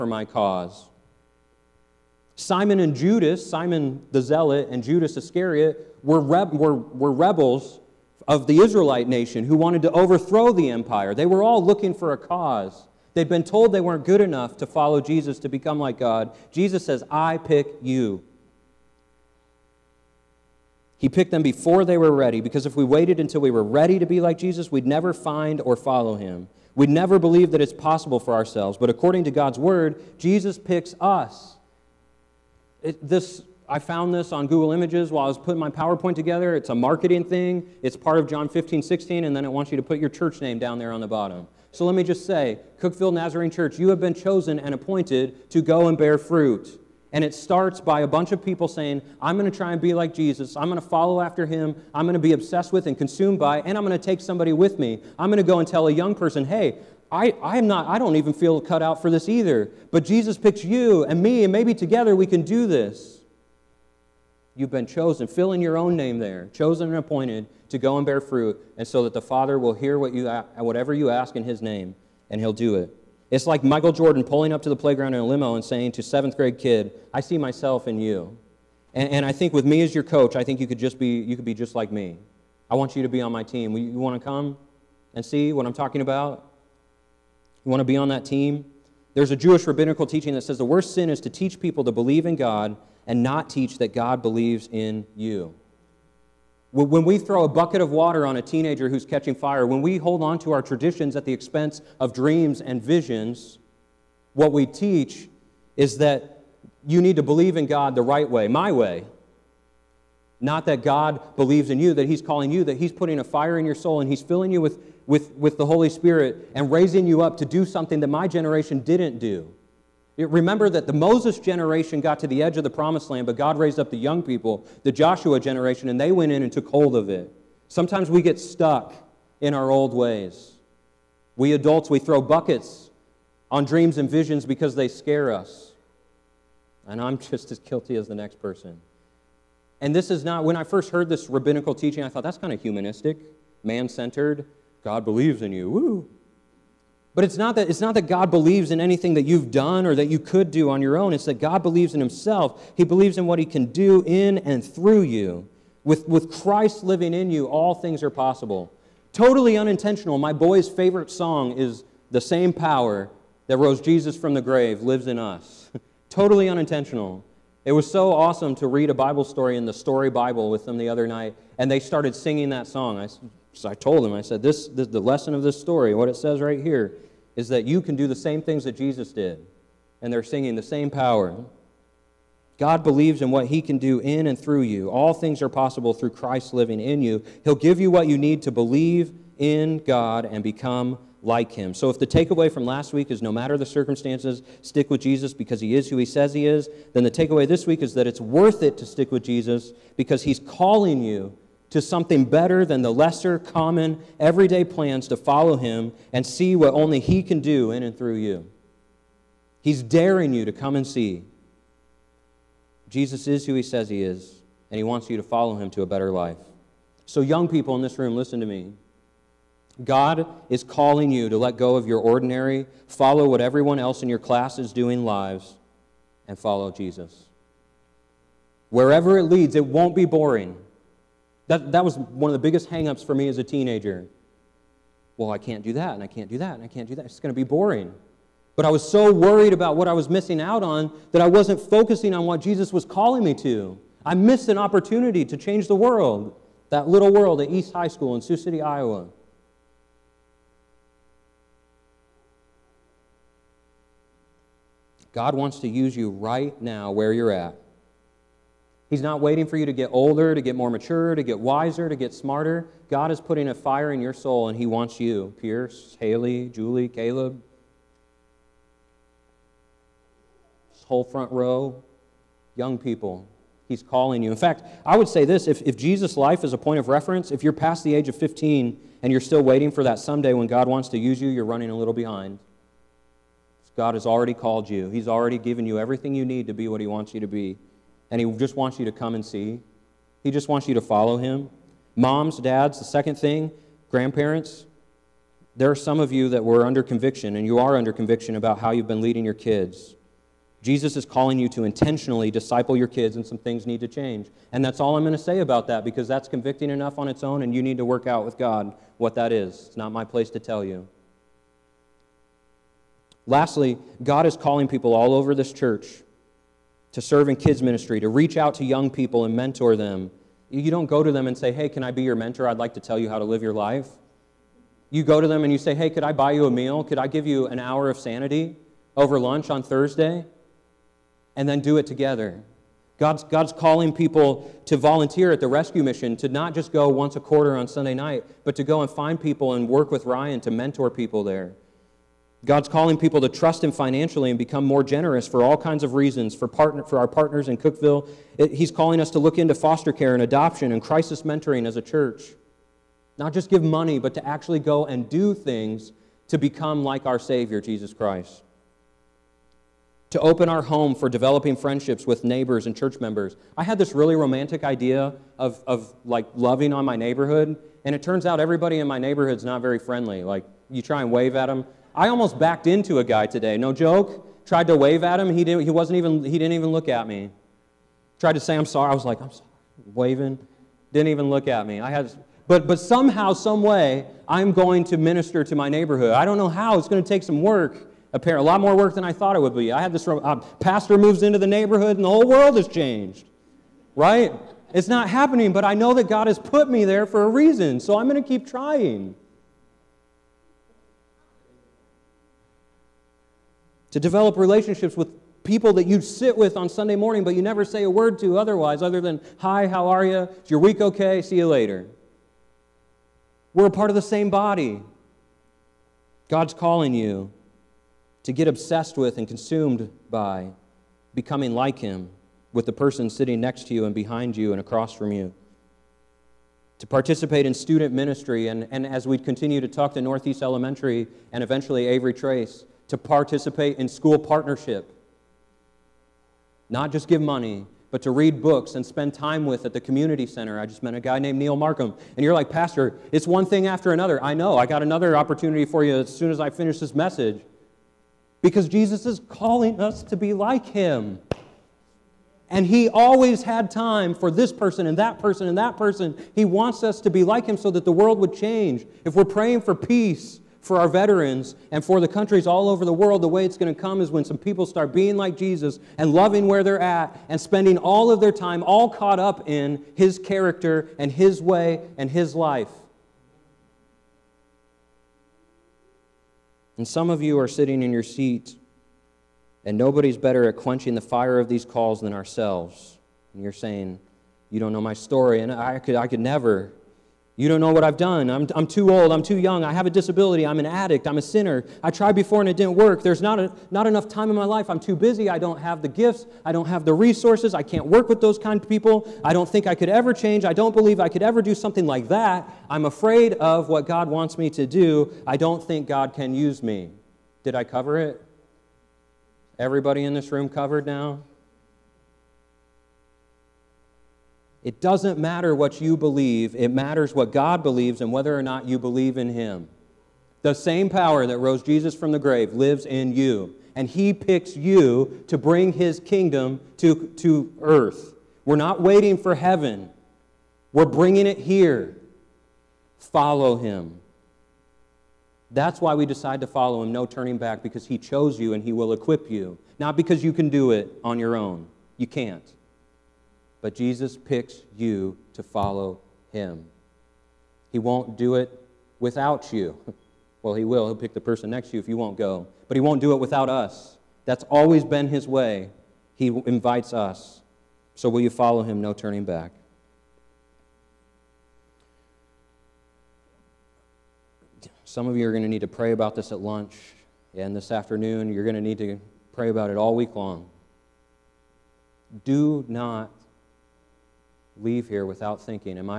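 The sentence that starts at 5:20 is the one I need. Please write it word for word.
You don't go to them and say, Hey, can I be your mentor?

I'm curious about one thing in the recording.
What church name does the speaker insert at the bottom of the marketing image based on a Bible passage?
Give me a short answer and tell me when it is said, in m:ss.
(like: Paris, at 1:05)
Cookeville Nazarene Church, at 0:42.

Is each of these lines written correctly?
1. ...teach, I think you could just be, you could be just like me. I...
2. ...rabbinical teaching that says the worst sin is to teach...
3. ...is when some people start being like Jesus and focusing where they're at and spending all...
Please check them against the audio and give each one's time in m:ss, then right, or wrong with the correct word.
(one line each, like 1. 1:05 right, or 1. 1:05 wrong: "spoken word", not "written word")
1. 1:20 wrong: "coach", not "teach"
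2. 1:29 right
3. 7:44 wrong: "loving", not "focusing".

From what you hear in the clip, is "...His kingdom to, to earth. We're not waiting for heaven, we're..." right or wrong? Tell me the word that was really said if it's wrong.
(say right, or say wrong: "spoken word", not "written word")
right.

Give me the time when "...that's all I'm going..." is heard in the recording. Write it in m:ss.
5:04.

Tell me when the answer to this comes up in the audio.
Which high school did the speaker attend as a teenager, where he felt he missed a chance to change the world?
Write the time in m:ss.
4:07.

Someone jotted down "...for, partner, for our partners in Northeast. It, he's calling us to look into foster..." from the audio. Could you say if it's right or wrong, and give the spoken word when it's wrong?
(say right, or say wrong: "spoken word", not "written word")
wrong: "Cookeville", not "Northeast".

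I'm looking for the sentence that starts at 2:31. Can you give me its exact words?
It's that God believes in Himself.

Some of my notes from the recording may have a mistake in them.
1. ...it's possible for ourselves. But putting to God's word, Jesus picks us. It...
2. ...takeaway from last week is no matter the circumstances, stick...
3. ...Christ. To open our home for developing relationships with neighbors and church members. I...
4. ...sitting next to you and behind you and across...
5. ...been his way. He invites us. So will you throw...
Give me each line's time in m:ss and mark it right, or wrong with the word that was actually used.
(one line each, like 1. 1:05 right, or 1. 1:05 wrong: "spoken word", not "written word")
1. 0:27 wrong: "according", not "putting"
2. 3:12 right
3. 5:57 wrong: "friendships", not "relationships"
4. 7:03 right
5. 9:14 wrong: "follow", not "throw".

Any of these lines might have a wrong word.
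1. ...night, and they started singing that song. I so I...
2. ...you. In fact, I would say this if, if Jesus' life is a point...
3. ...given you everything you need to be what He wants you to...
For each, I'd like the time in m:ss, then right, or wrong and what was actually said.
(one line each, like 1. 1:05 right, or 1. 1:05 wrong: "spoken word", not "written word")
1. 2:51 right
2. 4:34 right
3. 4:45 right.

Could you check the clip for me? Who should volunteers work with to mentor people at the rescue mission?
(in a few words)
Ryan.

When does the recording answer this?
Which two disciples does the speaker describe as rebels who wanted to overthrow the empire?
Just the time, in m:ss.
0:02.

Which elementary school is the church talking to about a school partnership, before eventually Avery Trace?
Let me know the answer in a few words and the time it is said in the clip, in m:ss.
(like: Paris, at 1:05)
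Northeast Elementary, at 7:10.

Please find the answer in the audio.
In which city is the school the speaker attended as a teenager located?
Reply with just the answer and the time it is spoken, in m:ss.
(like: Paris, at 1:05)
Sioux City, Iowa, at 4:08.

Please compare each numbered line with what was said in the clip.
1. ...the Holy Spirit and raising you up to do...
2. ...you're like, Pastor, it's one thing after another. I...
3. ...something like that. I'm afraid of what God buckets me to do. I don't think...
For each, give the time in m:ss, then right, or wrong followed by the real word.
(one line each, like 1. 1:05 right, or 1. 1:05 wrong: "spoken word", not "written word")
1. 1:55 right
2. 7:22 right
3. 8:21 wrong: "wants", not "buckets".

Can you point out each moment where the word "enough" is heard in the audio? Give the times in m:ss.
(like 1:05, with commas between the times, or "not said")
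0:14, 5:06, 8:13.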